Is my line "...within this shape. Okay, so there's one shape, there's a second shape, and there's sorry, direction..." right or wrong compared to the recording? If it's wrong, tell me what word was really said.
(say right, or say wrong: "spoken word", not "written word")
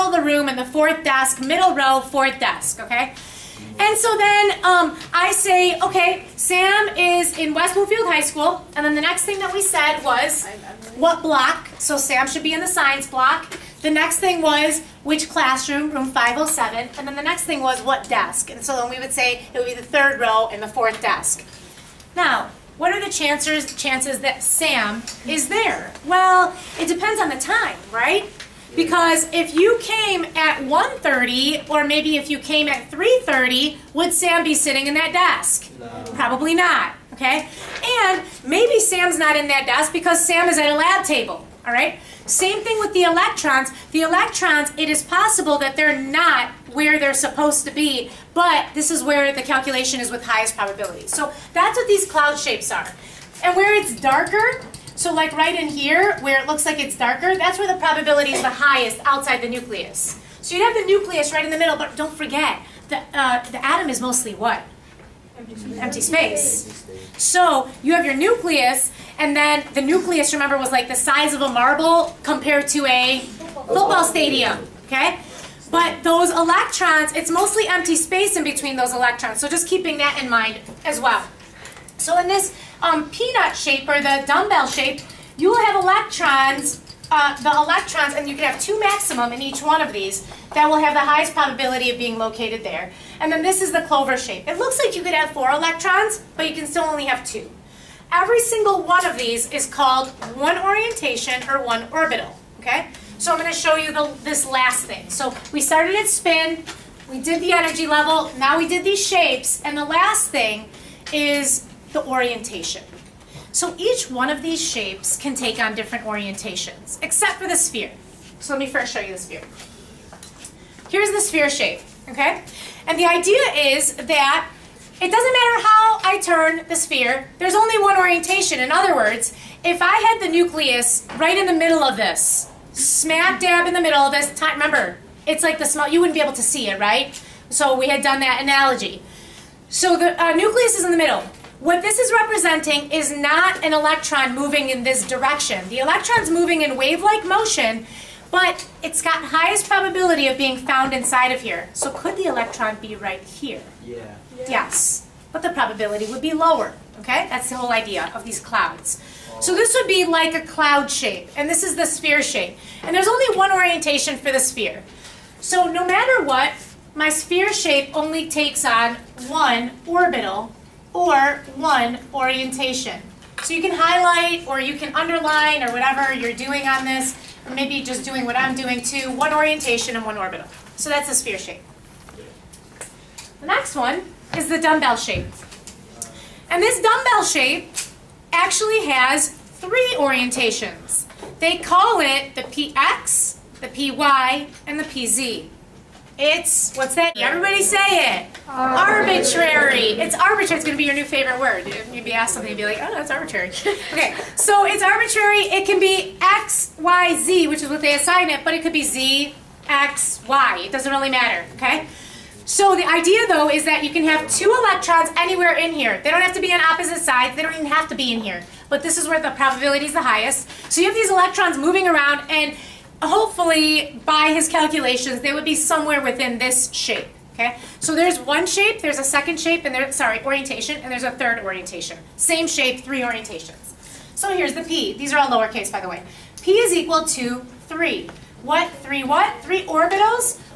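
wrong: "orientation", not "direction".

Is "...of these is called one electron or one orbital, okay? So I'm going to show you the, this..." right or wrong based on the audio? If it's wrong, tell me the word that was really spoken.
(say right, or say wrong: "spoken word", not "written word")
wrong: "orientation", not "electron".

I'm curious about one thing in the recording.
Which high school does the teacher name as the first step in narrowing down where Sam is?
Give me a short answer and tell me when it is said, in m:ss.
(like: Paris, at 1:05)
West Bloomfield High School, at 0:07.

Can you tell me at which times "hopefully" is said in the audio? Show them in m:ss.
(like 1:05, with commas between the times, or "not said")
3:43.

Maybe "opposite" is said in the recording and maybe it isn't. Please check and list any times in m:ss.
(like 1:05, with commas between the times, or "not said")
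3:36.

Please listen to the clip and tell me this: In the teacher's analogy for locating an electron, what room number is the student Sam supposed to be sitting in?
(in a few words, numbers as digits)
507.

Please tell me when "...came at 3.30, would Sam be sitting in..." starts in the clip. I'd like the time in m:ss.
0:32.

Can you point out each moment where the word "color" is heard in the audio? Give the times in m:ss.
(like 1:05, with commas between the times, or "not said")
not said.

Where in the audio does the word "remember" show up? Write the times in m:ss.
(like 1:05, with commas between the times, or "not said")
1:10, 2:14.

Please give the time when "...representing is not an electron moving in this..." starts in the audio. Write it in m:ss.
2:22.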